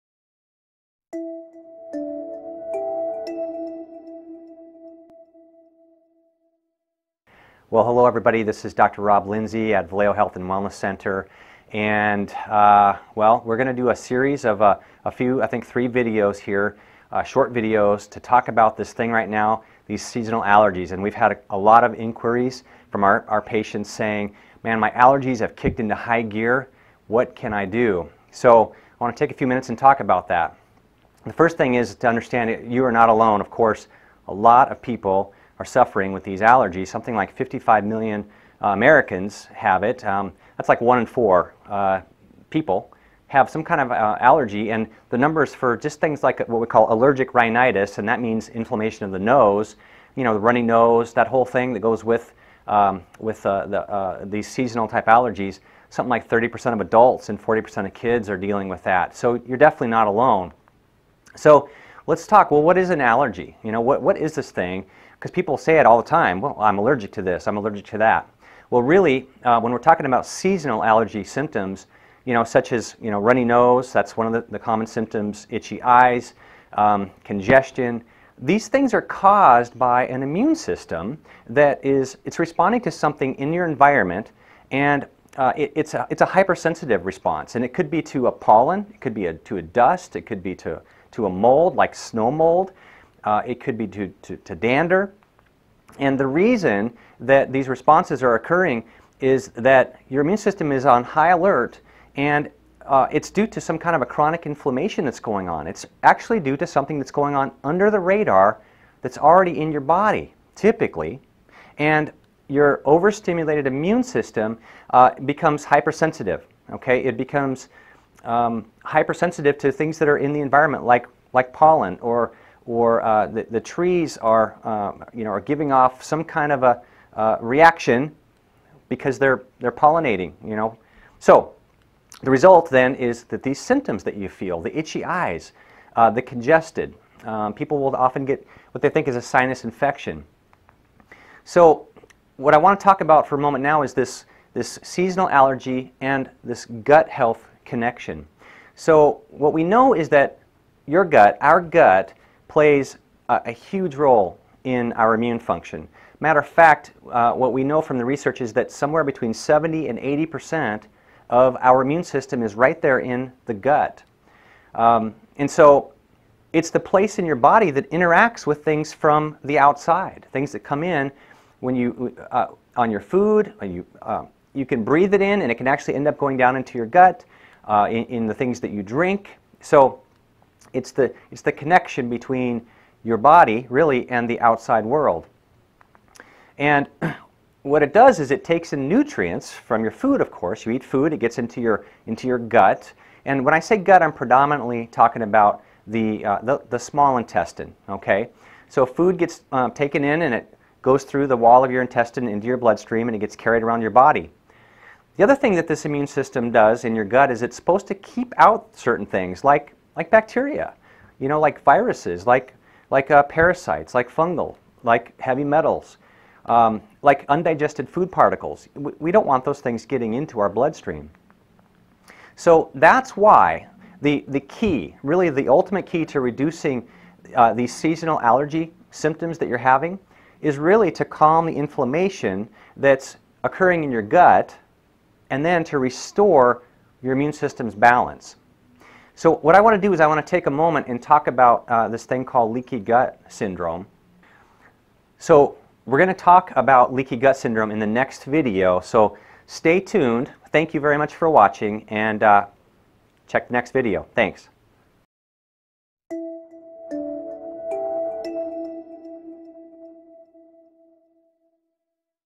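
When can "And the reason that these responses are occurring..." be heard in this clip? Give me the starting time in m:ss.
1:35.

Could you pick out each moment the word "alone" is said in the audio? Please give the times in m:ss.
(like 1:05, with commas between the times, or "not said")
0:33, 1:00.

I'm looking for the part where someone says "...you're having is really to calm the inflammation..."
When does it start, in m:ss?
3:49.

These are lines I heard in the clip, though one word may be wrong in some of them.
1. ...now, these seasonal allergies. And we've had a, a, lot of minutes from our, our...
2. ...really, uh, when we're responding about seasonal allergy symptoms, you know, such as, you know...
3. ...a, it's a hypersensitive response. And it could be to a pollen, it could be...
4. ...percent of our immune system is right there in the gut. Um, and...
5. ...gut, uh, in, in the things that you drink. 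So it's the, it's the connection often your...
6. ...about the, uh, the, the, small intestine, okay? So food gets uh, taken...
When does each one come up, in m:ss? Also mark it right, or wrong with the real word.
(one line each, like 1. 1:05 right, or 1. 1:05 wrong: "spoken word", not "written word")
1. 0:19 wrong: "inquiries", not "minutes"
2. 1:08 wrong: "talking", not "responding"
3. 1:25 right
4. 2:40 right
5. 2:56 wrong: "between", not "often"
6. 3:15 right.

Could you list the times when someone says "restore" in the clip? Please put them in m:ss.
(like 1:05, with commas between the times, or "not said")
3:55.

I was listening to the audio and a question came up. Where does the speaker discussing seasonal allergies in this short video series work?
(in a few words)
Valeo Health and Wellness Center.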